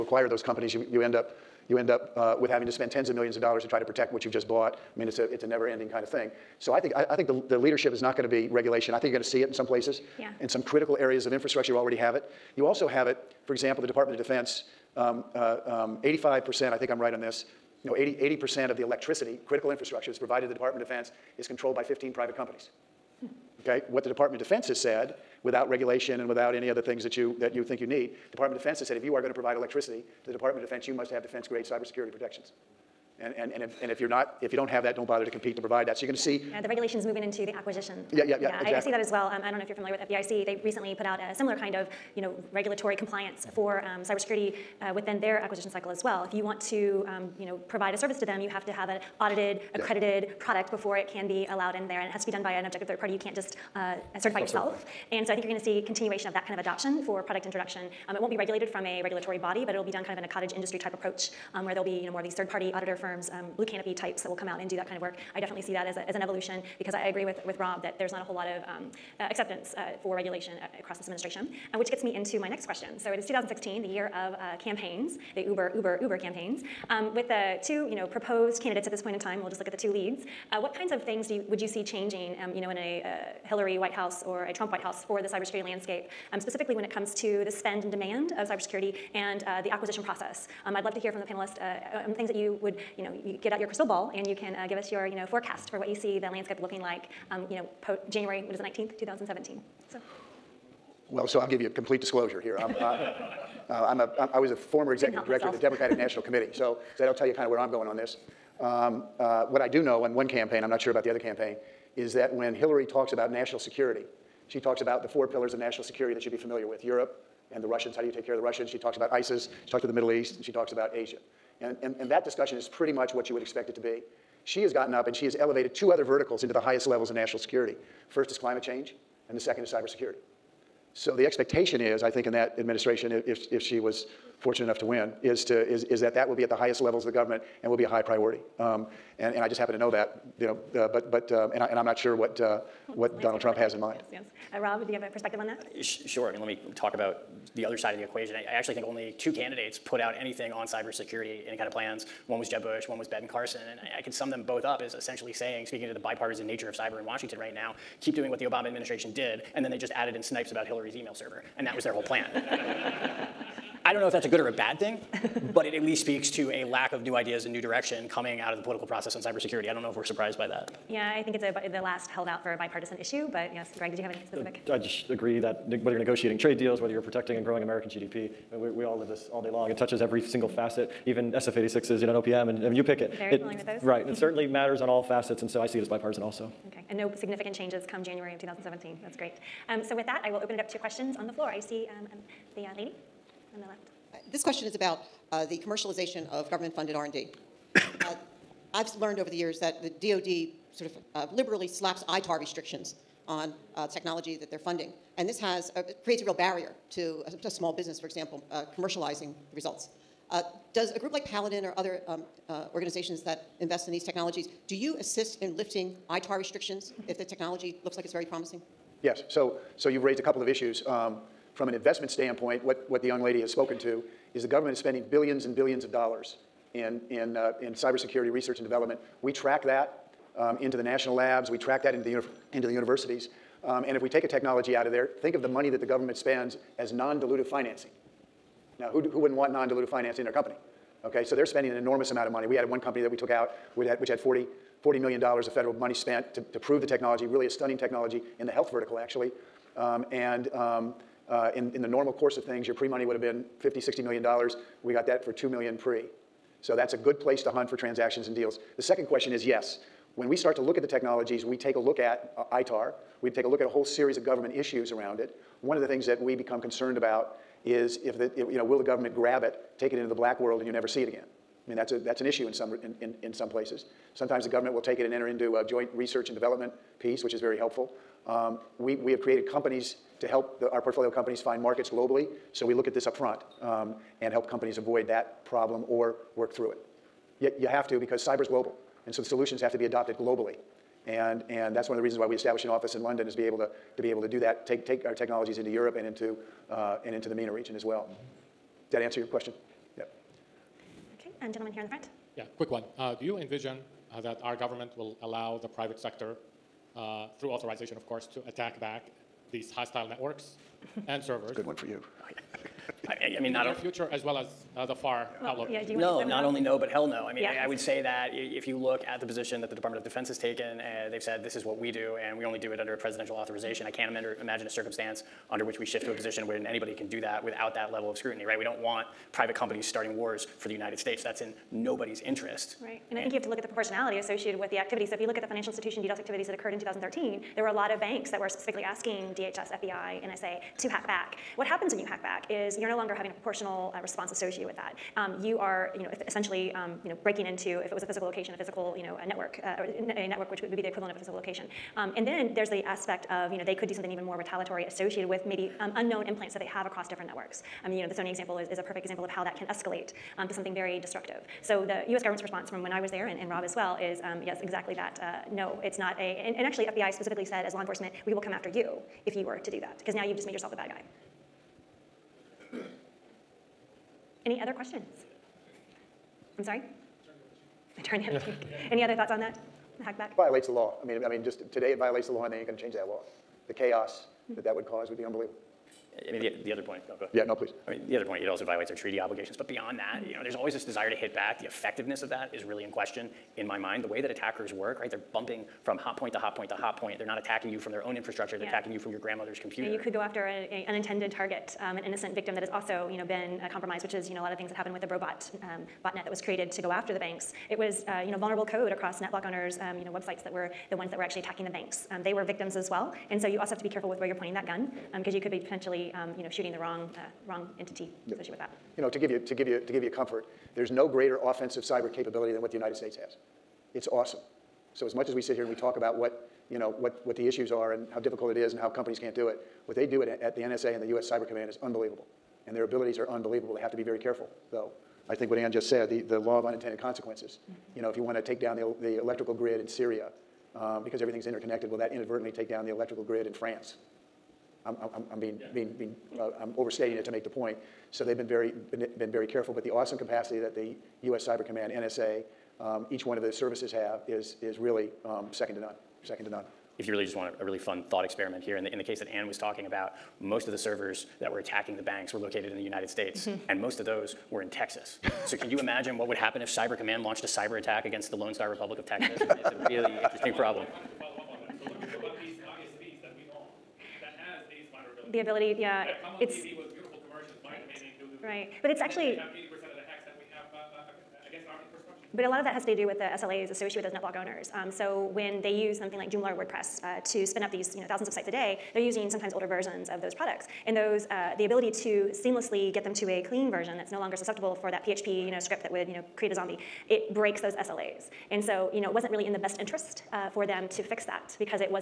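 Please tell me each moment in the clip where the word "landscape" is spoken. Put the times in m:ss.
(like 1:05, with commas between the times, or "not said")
1:25, 1:36.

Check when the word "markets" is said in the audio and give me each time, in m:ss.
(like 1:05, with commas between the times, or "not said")
4:41.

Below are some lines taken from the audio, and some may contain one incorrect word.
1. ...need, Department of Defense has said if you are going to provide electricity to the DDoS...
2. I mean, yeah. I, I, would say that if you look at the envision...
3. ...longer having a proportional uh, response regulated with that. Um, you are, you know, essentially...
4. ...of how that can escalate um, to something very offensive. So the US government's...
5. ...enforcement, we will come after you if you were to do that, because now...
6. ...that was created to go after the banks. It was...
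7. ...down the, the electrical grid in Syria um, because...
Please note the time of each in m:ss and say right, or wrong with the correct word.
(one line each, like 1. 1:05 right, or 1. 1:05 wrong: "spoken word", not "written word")
1. 0:27 wrong: "Department", not "DDoS"
2. 5:17 wrong: "position", not "envision"
3. 5:42 wrong: "associated", not "regulated"
4. 5:59 wrong: "destructive", not "offensive"
5. 6:07 right
6. 6:46 right
7. 7:18 right.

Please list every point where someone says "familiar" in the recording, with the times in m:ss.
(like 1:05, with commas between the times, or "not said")
0:39, 1:56, 3:03.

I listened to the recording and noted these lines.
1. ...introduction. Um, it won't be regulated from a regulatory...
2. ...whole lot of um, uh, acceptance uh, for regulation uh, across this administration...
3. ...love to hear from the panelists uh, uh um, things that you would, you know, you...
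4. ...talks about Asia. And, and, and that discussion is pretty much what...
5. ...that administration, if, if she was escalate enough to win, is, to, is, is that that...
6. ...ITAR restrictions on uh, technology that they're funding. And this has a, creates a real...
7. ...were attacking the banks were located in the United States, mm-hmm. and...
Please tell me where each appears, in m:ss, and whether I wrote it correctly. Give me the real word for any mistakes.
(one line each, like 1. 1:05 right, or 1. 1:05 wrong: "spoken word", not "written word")
1. 0:57 right
2. 1:08 right
3. 1:30 right
4. 2:00 right
5. 2:12 wrong: "fortunate", not "escalate"
6. 3:22 right
7. 7:41 right.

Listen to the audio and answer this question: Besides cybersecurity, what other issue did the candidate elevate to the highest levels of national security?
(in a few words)
Climate change.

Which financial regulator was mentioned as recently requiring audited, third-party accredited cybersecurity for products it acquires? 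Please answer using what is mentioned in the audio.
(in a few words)
FDIC.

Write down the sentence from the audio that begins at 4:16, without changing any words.
So that's a good place to hunt for transactions and deals.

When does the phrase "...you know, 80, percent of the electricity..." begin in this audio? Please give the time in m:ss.
0:17.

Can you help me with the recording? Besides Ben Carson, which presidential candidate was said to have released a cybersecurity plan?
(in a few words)
Jeb Bush.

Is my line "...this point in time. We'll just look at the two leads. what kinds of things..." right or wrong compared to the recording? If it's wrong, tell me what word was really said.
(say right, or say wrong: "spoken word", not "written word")
right.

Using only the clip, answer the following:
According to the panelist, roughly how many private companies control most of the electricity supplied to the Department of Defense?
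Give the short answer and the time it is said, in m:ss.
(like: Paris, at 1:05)
15, at 0:21.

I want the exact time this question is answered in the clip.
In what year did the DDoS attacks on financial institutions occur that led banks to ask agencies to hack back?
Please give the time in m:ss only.
5:36.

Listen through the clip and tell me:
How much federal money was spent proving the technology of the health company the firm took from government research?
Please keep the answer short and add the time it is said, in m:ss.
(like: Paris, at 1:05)
$40 million, at 4:04.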